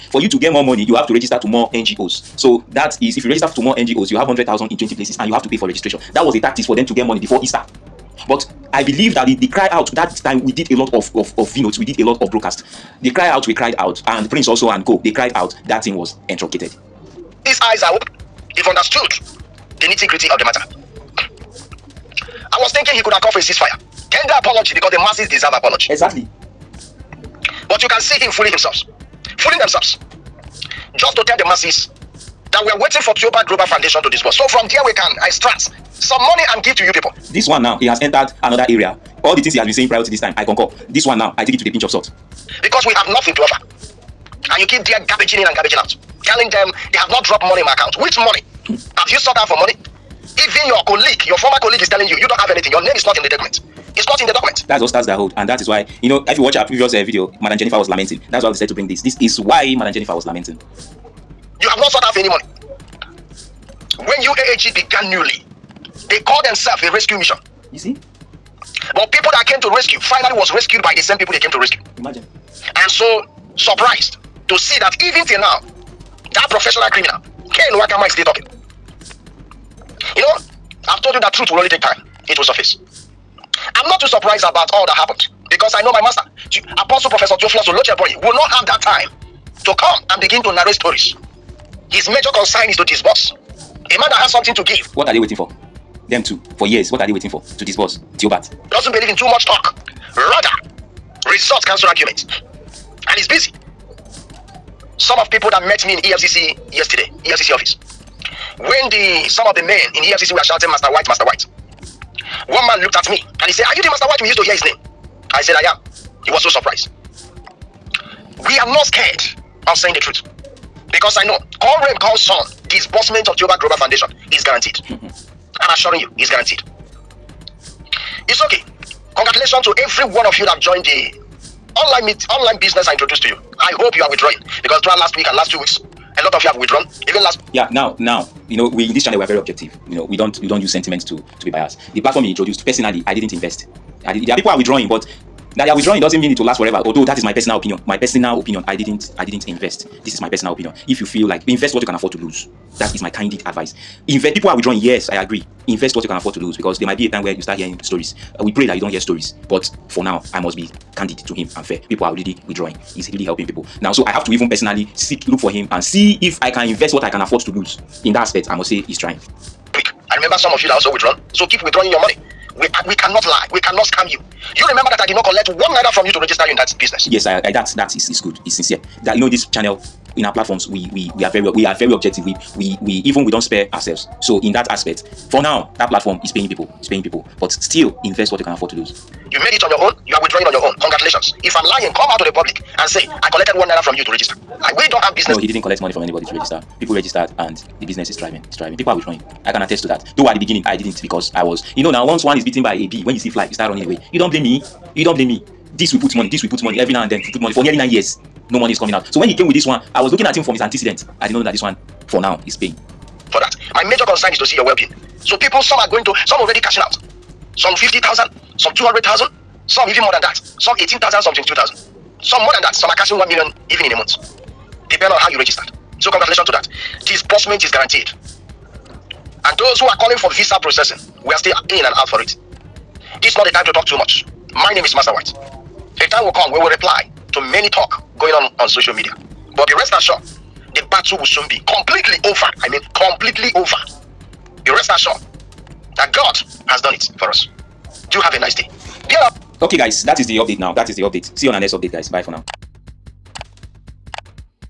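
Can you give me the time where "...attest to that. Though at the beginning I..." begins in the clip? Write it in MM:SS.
03:19.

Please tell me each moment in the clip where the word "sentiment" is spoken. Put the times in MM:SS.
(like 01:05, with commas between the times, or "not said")
02:20.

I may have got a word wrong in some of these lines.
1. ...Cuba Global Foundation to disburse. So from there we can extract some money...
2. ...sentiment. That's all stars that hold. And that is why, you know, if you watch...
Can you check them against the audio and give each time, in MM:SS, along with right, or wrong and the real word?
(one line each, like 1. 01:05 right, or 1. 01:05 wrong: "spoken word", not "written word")
1. 00:33 right
2. 00:54 wrong: "document", not "sentiment".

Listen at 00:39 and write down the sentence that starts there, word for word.
All the things he has been saying prior to this time, I concur.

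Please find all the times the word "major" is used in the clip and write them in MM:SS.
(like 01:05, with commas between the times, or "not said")
01:32, 03:33.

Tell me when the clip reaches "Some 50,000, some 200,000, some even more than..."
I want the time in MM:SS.
03:37.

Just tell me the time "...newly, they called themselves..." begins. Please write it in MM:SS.
01:05.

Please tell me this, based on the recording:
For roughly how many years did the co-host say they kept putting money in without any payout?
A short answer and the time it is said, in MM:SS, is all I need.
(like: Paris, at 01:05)
9, at 03:27.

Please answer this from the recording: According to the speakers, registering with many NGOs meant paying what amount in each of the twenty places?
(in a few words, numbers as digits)
100000.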